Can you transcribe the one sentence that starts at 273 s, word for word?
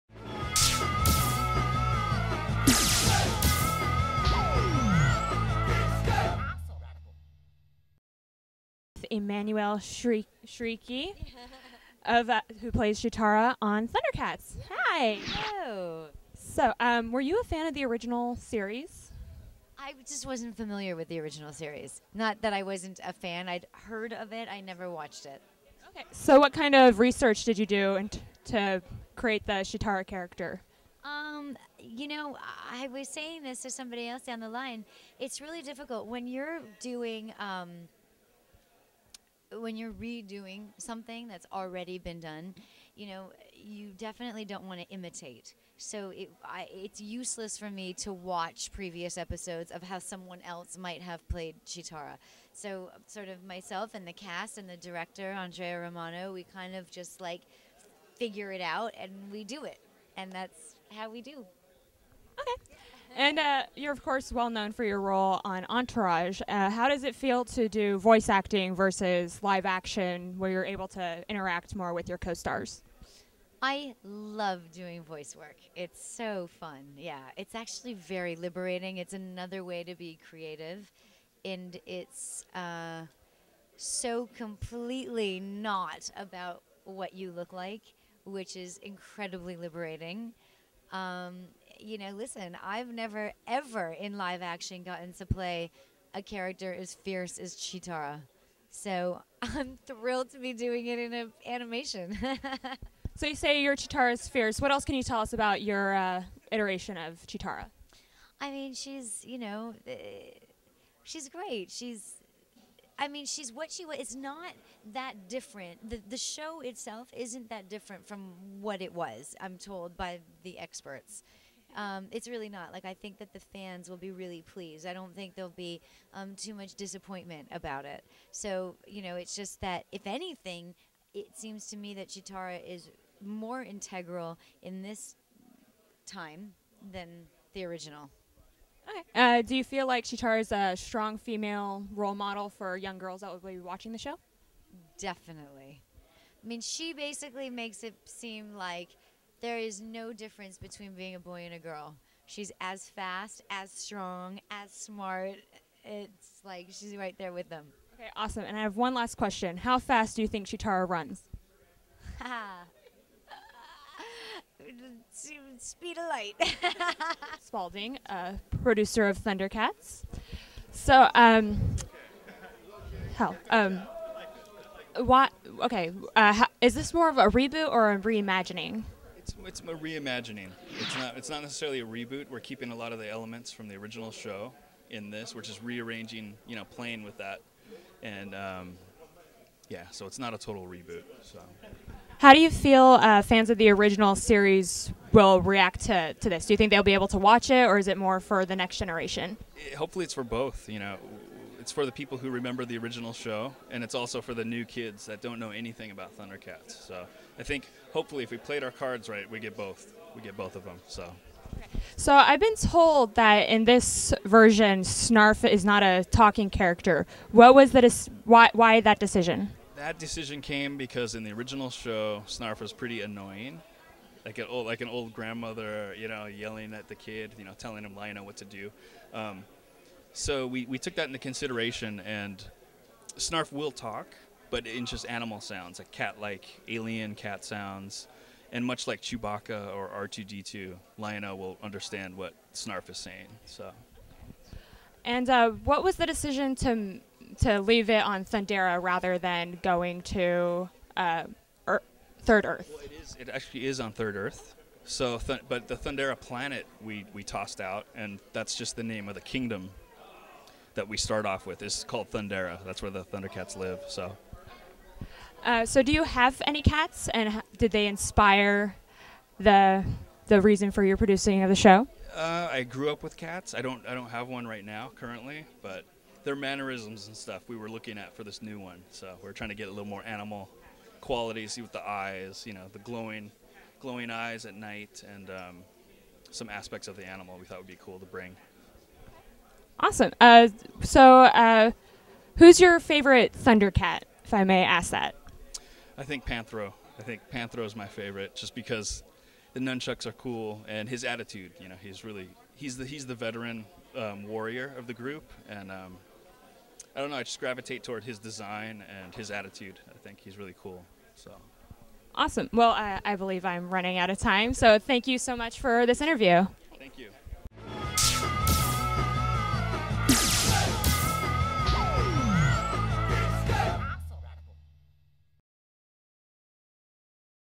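I don't I don't have one right now currently, but their mannerisms and stuff we were looking at for this new one.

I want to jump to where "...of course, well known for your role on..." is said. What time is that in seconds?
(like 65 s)
63 s.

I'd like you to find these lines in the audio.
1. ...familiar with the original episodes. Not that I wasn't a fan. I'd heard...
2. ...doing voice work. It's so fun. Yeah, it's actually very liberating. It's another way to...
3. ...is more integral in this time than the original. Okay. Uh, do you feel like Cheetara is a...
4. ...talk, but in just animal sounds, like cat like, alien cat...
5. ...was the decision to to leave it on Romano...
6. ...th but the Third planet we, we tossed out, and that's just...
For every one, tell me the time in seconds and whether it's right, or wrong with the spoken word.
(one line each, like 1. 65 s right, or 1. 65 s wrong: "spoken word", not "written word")
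1. 20 s wrong: "series", not "episodes"
2. 74 s right
3. 132 s right
4. 233 s right
5. 245 s wrong: "Thundera", not "Romano"
6. 255 s wrong: "Thundera", not "Third".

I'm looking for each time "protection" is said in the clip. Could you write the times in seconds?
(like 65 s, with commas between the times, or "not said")
not said.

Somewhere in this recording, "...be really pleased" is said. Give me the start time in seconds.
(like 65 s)
123 s.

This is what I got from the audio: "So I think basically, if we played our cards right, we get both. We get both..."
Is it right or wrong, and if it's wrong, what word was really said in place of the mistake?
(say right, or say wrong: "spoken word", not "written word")
wrong: "hopefully", not "basically".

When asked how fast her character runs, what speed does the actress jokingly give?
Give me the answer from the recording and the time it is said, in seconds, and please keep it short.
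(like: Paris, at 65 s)
Speed of light, at 165 s.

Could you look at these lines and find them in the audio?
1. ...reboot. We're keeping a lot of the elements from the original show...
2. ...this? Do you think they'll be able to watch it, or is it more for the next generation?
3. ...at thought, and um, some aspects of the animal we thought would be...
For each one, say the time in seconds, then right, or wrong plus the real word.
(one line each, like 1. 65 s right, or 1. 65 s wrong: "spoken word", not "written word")
1. 181 s right
2. 196 s right
3. 284 s wrong: "night", not "thought".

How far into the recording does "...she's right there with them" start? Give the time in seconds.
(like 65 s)
156 s.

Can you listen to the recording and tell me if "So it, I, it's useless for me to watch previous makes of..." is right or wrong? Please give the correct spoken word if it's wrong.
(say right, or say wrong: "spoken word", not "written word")
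wrong: "episodes", not "makes".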